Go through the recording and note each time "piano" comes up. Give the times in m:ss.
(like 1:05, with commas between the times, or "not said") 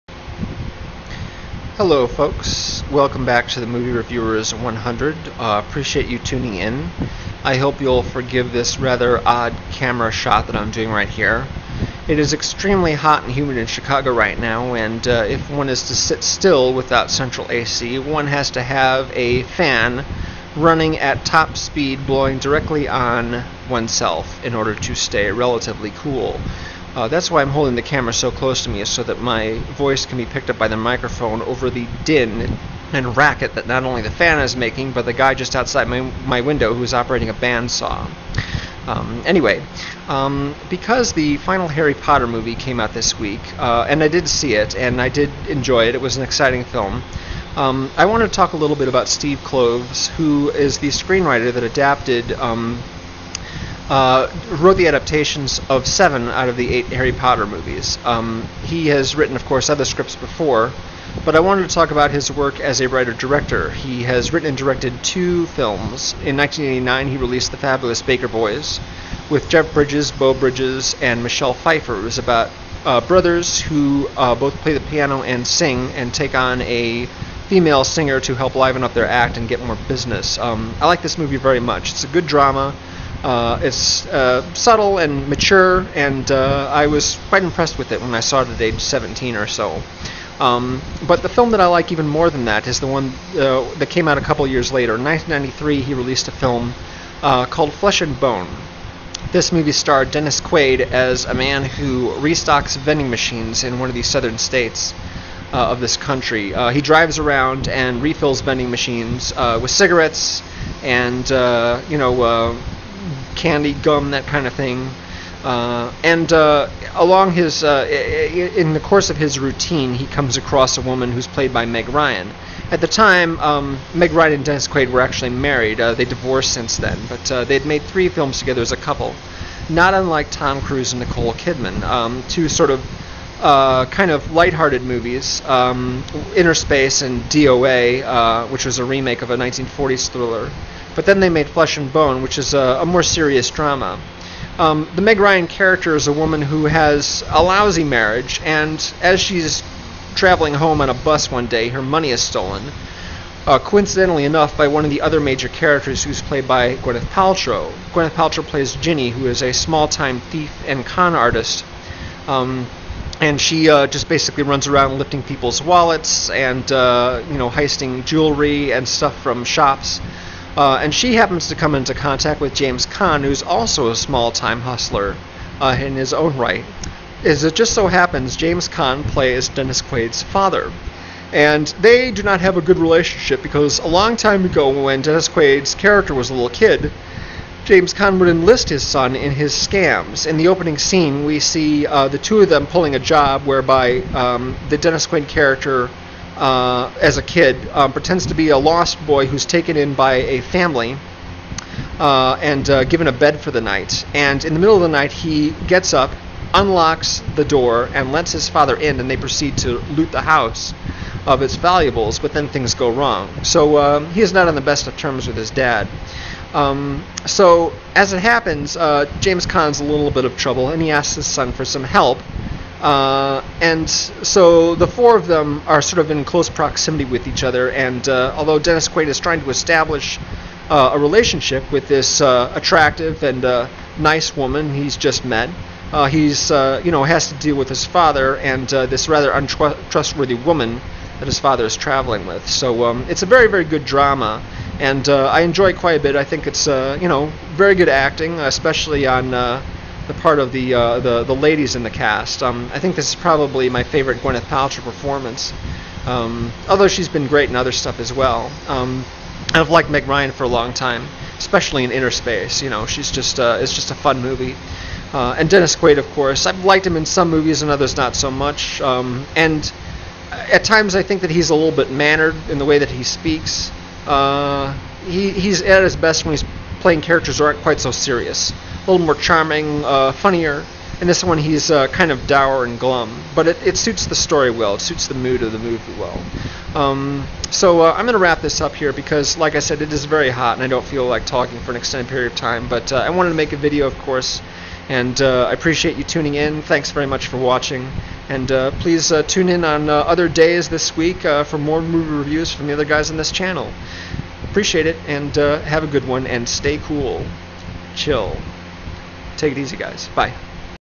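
1:14.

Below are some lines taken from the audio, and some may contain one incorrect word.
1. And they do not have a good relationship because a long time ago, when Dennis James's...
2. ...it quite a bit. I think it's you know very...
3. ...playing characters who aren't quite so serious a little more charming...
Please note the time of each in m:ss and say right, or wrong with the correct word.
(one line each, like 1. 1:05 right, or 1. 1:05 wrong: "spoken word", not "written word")
1. 3:01 wrong: "Quaid", not "James"
2. 4:05 right
3. 4:36 right.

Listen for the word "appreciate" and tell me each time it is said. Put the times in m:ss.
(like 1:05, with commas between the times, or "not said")
0:05, 4:55, 5:04.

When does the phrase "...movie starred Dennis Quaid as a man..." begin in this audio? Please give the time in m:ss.
1:39.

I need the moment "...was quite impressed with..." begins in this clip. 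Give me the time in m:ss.
1:26.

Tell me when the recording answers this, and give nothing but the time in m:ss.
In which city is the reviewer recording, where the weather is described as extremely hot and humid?
0:13.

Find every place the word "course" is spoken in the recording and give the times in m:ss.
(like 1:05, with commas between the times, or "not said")
0:59, 1:58, 4:26, 4:53.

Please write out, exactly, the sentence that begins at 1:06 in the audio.
In 1989, he released The Fabulous Baker Boys with Jeff Bridges, Beau Bridges, and Michelle Pfeiffer.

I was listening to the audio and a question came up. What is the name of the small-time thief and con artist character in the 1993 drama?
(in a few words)
Ginny.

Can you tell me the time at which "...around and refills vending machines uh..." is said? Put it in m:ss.
1:47.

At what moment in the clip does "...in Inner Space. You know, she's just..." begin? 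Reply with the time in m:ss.
4:21.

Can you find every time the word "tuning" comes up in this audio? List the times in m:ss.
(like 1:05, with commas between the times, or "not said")
0:06, 4:56.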